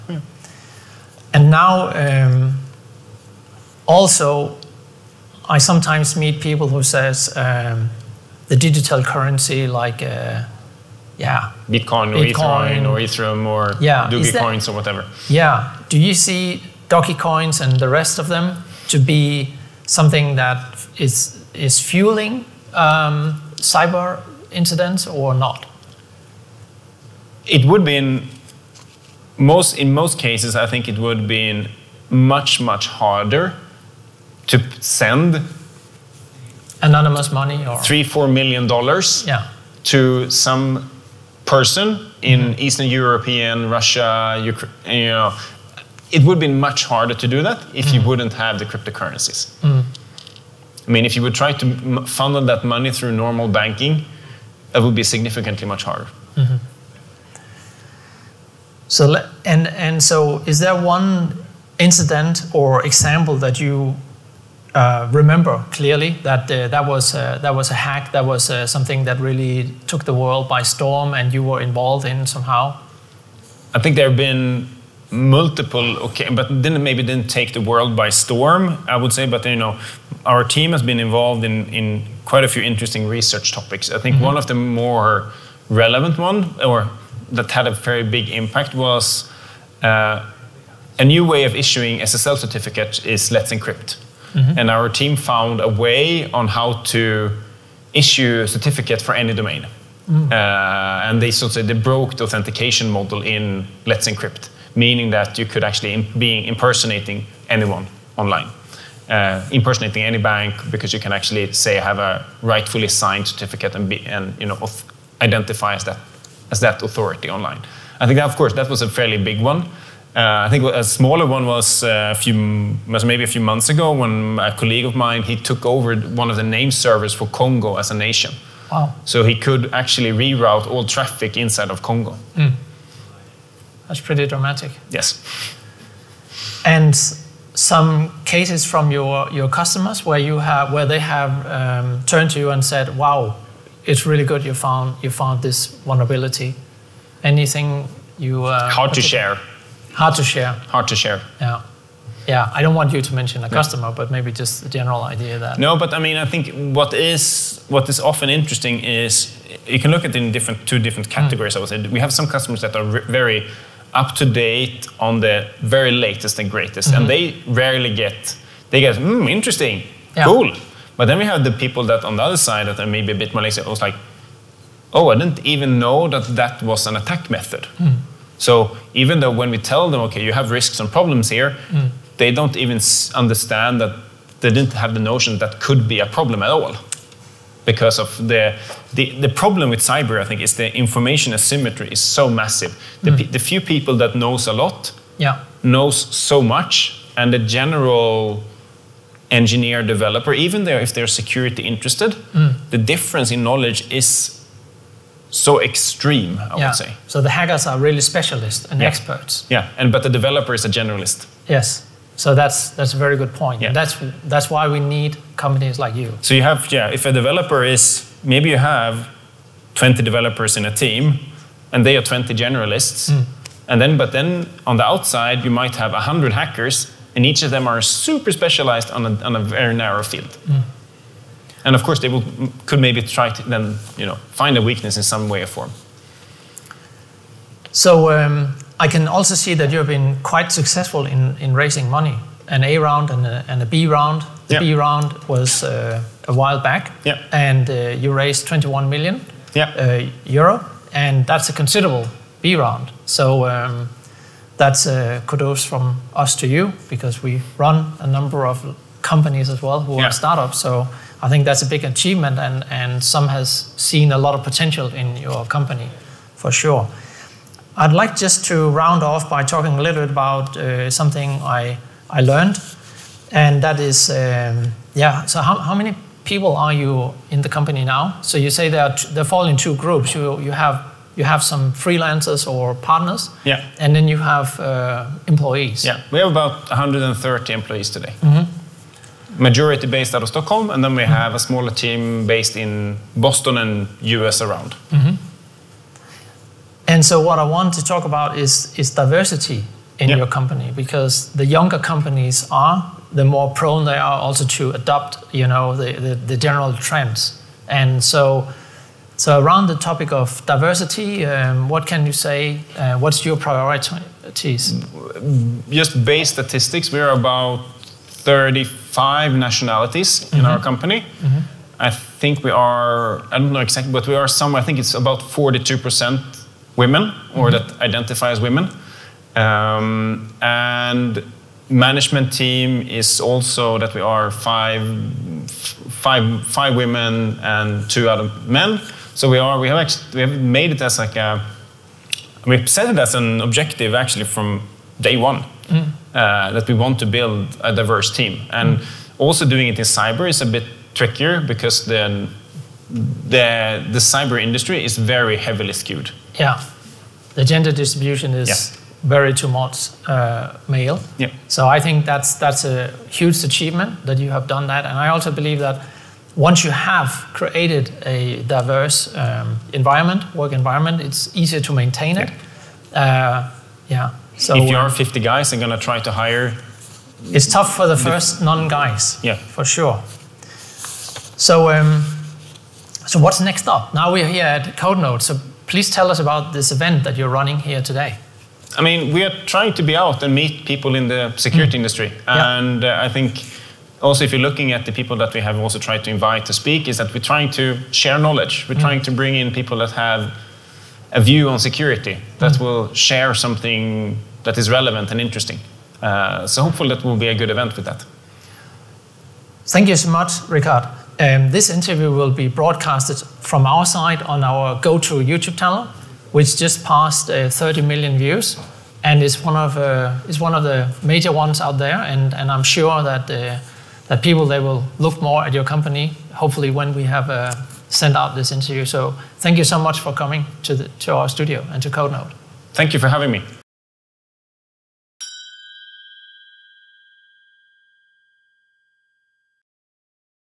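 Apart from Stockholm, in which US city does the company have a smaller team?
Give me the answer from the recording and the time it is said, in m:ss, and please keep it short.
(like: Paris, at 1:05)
Boston, at 4:53.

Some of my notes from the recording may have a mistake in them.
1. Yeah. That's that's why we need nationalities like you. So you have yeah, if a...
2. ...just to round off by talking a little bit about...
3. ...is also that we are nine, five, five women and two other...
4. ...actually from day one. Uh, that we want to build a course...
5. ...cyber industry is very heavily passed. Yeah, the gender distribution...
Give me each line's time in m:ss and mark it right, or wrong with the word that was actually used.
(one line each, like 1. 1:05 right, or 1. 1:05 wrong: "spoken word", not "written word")
1. 3:33 wrong: "companies", not "nationalities"
2. 4:28 right
3. 5:32 wrong: "five", not "nine"
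4. 5:43 wrong: "diverse", not "course"
5. 5:53 wrong: "skewed", not "passed".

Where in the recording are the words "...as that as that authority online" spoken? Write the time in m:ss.
1:55.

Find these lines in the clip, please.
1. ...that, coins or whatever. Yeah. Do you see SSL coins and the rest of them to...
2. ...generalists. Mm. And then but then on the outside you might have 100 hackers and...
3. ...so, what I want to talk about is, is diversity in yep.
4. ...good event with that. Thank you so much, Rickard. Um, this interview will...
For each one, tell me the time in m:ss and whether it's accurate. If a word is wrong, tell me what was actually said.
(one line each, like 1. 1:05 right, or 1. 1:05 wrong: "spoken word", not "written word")
1. 0:14 wrong: "Doge", not "SSL"
2. 3:42 right
3. 4:57 right
4. 6:47 right.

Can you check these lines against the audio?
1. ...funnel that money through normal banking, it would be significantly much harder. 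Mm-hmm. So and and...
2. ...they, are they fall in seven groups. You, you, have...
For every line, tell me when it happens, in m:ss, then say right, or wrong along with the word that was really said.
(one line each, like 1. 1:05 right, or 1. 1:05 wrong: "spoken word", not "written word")
1. 0:52 right
2. 4:38 wrong: "two", not "seven".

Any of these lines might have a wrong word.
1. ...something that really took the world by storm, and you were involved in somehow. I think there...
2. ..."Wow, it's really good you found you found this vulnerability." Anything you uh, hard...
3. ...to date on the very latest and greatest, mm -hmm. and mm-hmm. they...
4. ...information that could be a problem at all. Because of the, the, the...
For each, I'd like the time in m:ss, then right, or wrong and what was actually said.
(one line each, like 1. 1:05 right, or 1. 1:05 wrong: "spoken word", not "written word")
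1. 1:08 right
2. 2:22 right
3. 2:44 right
4. 3:04 wrong: "notion", not "information".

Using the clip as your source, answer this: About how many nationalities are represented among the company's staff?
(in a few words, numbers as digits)
35.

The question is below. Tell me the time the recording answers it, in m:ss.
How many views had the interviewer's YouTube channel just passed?
6:57.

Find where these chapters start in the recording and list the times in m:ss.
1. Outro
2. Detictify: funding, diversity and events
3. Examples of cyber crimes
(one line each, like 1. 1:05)
1. 6:49
2. 3:59
3. 1:00.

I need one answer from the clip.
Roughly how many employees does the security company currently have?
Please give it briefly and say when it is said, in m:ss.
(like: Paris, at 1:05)
130, at 4:46.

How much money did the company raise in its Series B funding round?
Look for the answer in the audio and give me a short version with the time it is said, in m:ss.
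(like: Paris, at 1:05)
21 million euro, at 4:08.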